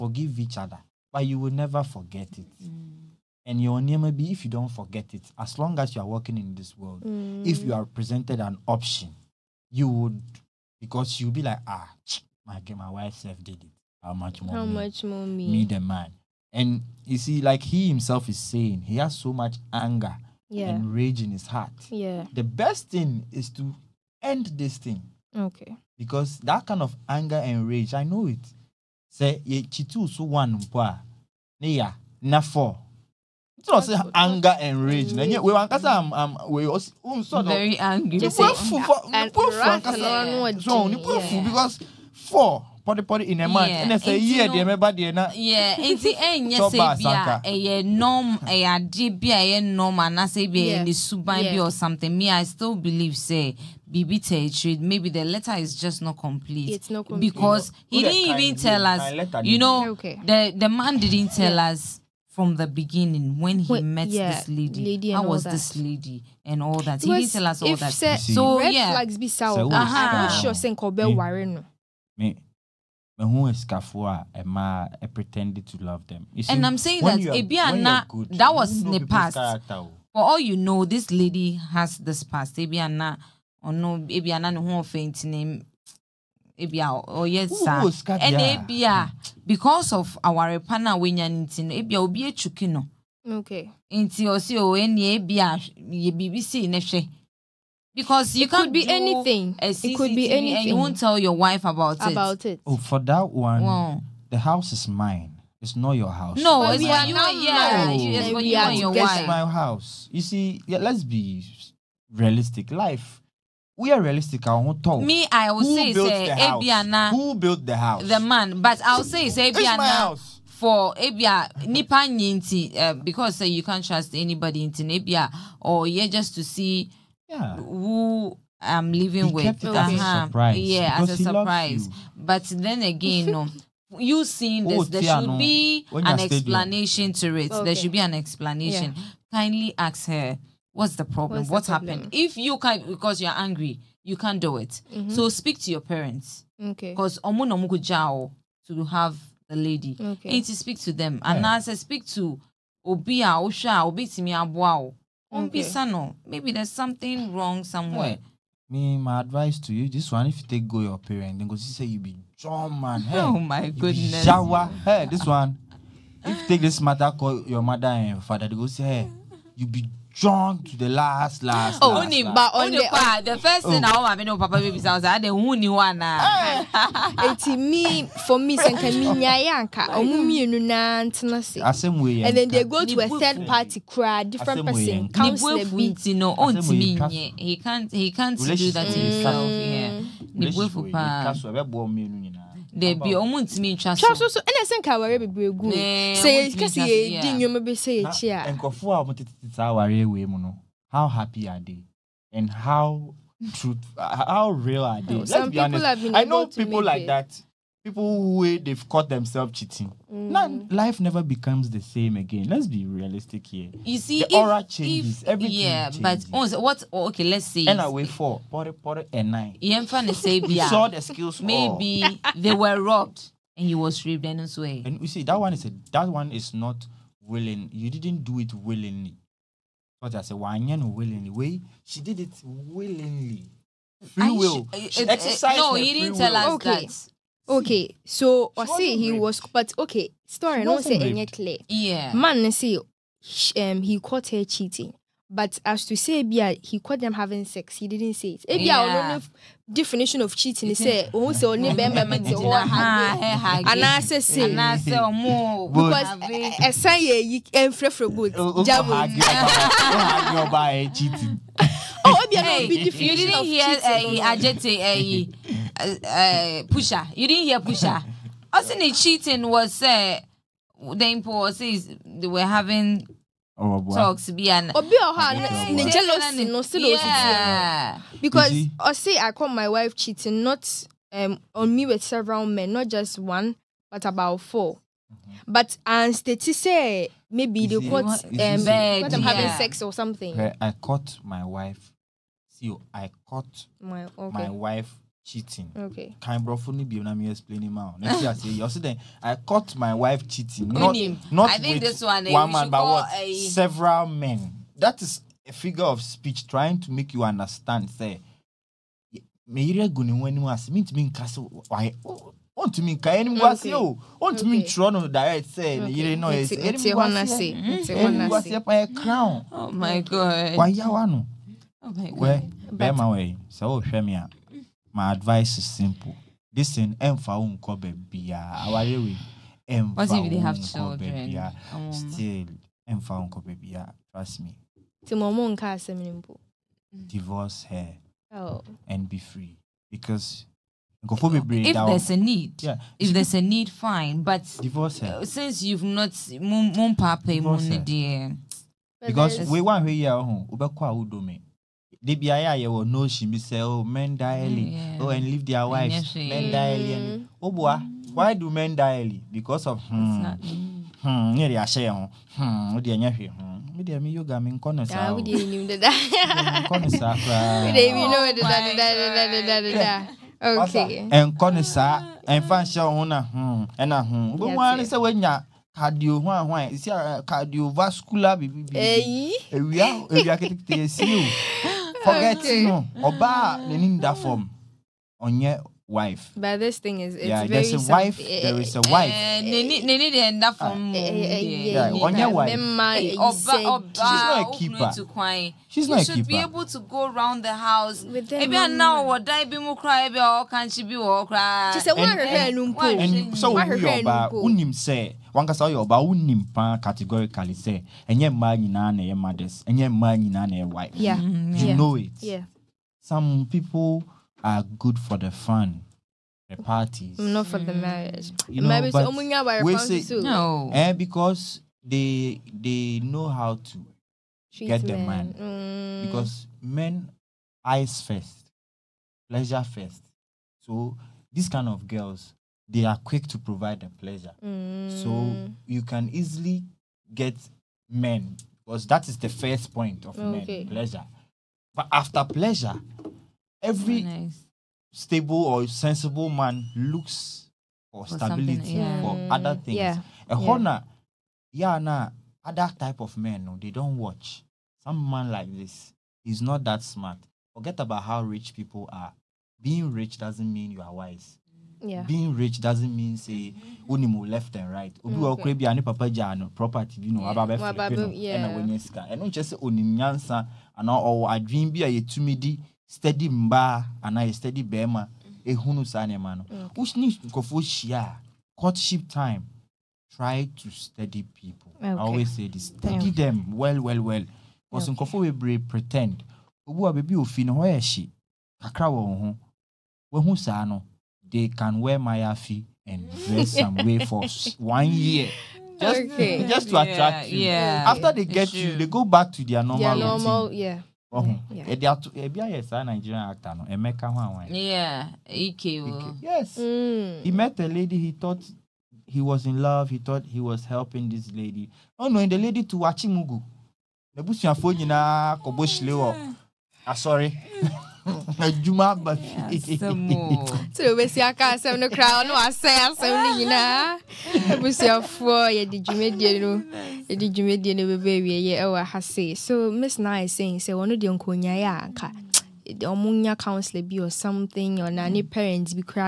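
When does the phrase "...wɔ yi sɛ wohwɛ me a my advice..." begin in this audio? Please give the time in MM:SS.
05:23.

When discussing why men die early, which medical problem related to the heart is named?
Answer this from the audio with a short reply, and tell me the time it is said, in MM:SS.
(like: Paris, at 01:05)
Cardiovascular, at 06:17.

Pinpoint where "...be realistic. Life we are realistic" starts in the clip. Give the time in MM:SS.
01:51.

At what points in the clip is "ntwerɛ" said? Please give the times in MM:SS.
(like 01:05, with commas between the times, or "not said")
05:14.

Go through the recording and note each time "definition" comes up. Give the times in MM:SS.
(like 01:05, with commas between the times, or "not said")
04:09, 04:22.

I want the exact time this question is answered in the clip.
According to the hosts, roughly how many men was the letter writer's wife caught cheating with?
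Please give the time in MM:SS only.
04:44.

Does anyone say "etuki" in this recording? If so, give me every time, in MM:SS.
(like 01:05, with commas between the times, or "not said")
01:32.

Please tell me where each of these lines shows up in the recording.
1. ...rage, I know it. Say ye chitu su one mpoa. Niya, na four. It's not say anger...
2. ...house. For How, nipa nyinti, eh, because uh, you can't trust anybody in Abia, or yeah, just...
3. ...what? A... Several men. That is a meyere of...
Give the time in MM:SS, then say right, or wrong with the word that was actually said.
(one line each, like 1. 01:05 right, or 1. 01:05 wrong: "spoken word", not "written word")
1. 00:27 right
2. 01:59 wrong: "Abia", not "How"
3. 05:02 wrong: "figure", not "meyere".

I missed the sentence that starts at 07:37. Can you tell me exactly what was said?
Forget about how rich people are.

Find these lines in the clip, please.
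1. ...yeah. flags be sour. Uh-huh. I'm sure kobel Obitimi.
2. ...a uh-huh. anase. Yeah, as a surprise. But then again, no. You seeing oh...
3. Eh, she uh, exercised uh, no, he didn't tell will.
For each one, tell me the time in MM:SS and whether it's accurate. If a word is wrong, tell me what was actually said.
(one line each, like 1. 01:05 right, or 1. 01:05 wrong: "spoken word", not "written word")
1. 01:08 wrong: "Warren", not "Obitimi"
2. 02:09 wrong: "surprise", not "anase"
3. 03:54 right.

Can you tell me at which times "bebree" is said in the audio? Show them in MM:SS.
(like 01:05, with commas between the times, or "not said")
03:15, 08:05.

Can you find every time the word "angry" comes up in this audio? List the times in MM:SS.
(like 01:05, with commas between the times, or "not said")
00:37, 02:23.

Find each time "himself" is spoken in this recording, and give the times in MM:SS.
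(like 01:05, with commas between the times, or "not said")
00:17, 03:08.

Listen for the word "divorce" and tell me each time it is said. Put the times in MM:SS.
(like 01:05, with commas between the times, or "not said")
05:37, 05:44.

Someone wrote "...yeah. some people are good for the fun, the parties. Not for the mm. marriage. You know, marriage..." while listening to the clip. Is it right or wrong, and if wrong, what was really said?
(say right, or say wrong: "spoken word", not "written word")
right.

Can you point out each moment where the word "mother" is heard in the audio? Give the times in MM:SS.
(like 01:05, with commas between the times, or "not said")
02:47, 06:49.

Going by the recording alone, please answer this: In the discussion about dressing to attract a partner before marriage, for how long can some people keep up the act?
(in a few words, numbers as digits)
1 year.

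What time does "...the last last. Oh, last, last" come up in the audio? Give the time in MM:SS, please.
02:50.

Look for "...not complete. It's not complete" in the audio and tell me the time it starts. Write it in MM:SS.
00:56.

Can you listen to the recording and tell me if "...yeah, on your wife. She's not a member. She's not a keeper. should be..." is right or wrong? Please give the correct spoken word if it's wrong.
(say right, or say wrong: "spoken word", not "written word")
wrong: "keeper", not "member".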